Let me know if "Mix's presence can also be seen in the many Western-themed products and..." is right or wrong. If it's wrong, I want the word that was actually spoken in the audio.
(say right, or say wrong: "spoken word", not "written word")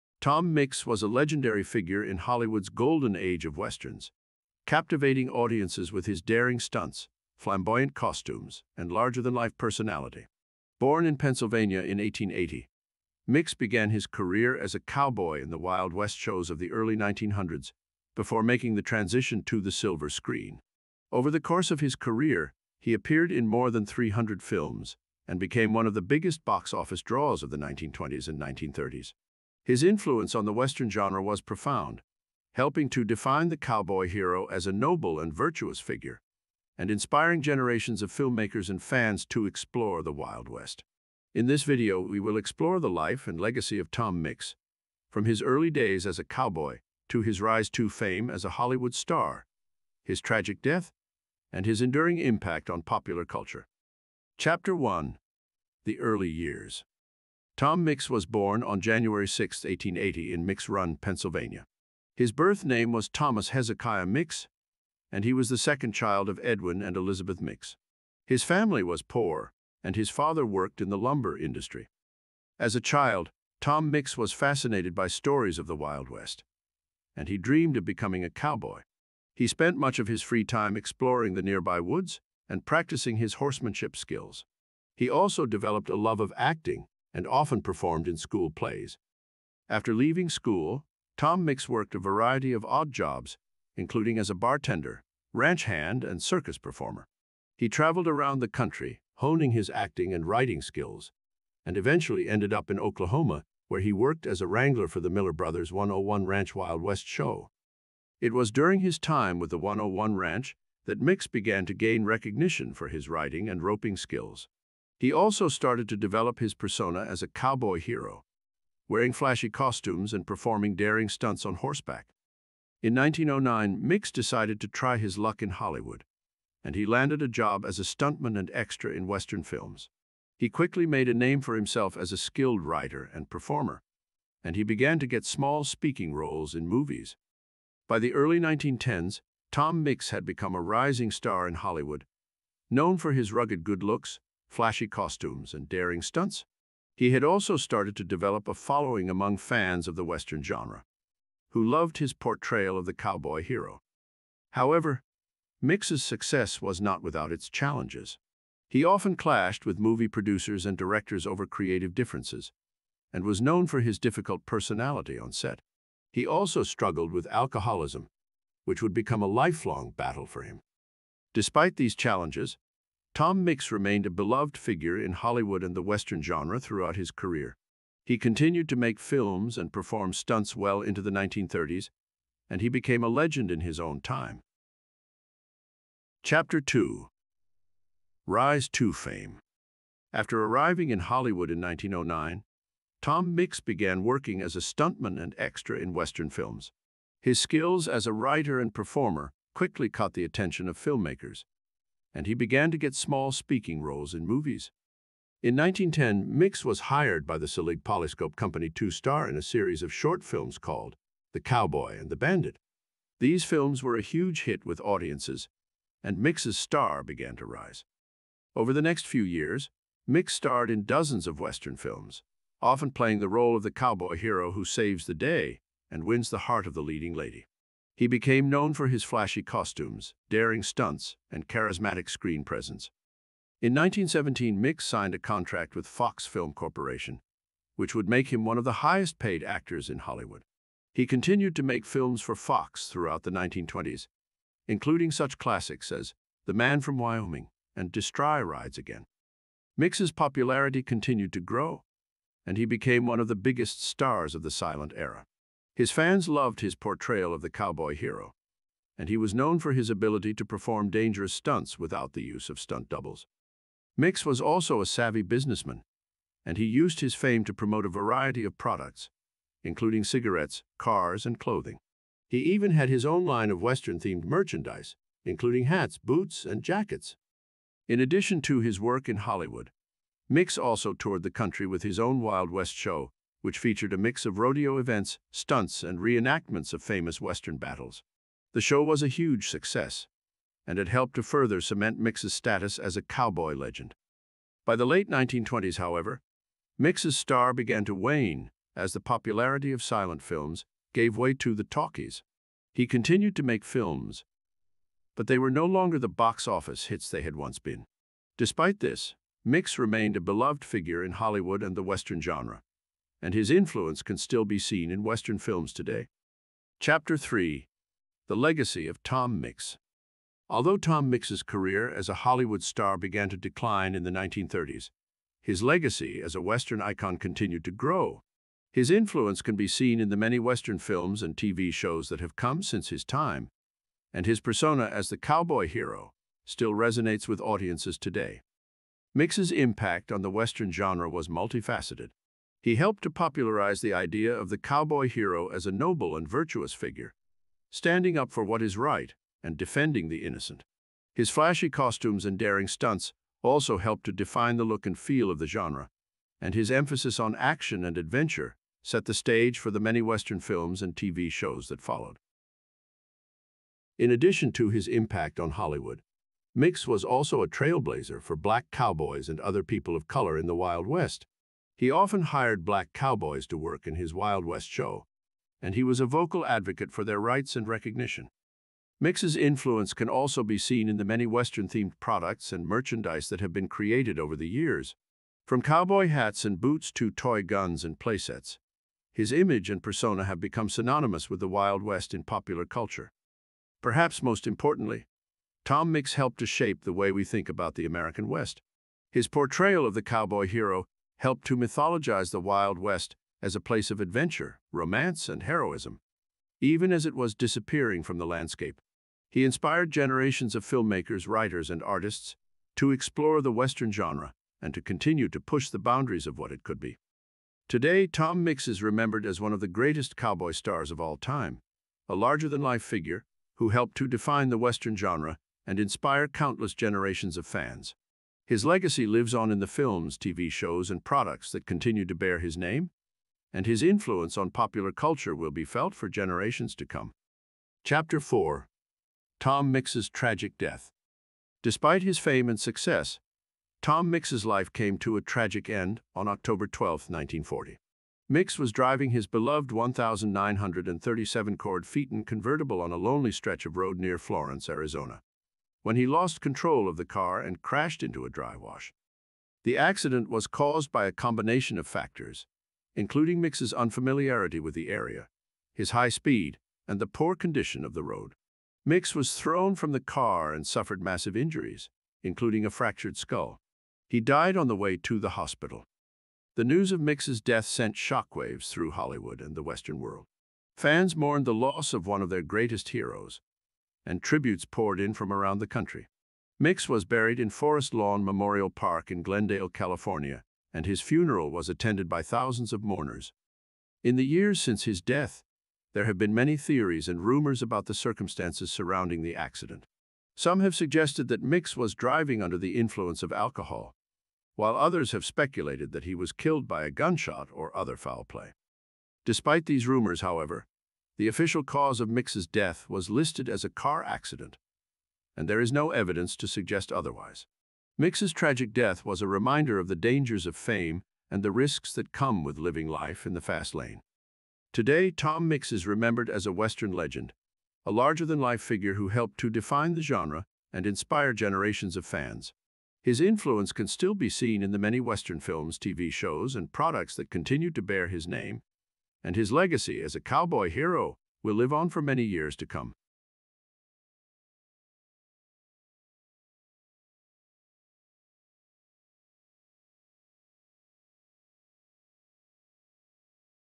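wrong: "influence", not "presence".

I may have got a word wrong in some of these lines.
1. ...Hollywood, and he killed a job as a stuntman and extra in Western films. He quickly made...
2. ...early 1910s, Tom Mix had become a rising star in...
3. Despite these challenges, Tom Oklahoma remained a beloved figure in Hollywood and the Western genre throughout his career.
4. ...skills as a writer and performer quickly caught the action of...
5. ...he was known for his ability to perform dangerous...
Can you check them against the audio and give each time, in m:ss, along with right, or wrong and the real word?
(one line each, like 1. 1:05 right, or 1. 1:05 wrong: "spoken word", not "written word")
1. 2:05 wrong: "landed", not "killed"
2. 2:18 right
3. 2:51 wrong: "Mix", not "Oklahoma"
4. 3:17 wrong: "attention", not "action"
5. 4:19 right.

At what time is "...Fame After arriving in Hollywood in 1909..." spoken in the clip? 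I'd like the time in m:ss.
3:08.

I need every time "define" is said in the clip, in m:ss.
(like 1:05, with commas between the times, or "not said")
0:33, 5:54, 7:04, 8:49.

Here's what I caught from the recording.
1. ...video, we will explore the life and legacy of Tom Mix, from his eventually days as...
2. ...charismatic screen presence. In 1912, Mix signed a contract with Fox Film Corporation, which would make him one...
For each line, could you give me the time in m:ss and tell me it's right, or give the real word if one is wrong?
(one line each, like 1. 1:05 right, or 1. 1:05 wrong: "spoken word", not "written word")
1. 0:41 wrong: "early", not "eventually"
2. 3:51 wrong: "1917", not "1912".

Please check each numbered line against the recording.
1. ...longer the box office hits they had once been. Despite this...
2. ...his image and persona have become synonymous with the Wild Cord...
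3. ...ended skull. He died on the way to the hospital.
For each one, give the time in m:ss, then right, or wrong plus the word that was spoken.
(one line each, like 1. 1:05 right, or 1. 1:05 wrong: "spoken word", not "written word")
1. 5:05 right
2. 6:29 wrong: "West", not "Cord"
3. 7:52 wrong: "fractured", not "ended".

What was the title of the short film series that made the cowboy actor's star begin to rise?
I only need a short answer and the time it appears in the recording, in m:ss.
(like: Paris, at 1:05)
The Cowboy and the Bandit, at 3:31.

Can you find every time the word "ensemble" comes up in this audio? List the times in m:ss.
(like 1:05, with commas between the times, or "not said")
not said.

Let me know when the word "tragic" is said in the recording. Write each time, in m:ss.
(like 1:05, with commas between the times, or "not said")
0:50, 7:20, 7:25, 8:38.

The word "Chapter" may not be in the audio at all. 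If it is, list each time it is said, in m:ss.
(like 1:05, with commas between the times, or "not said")
0:54, 3:06, 5:16, 7:17.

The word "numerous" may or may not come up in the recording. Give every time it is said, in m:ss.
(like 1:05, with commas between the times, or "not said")
not said.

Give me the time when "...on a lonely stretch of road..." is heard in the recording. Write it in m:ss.
7:32.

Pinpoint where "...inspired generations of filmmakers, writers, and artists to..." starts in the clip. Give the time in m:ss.
6:49.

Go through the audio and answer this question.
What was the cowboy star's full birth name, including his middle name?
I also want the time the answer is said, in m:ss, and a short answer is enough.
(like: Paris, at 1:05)
Thomas Hezekiah Mix, at 1:03.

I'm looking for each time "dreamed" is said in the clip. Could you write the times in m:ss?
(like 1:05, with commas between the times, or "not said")
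1:17.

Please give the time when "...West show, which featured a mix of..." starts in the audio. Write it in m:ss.
4:42.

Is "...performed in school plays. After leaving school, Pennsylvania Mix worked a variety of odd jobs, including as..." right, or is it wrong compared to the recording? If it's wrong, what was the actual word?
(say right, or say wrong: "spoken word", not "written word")
wrong: "Tom", not "Pennsylvania".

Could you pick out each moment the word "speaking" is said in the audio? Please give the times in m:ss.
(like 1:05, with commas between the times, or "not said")
2:15, 3:23.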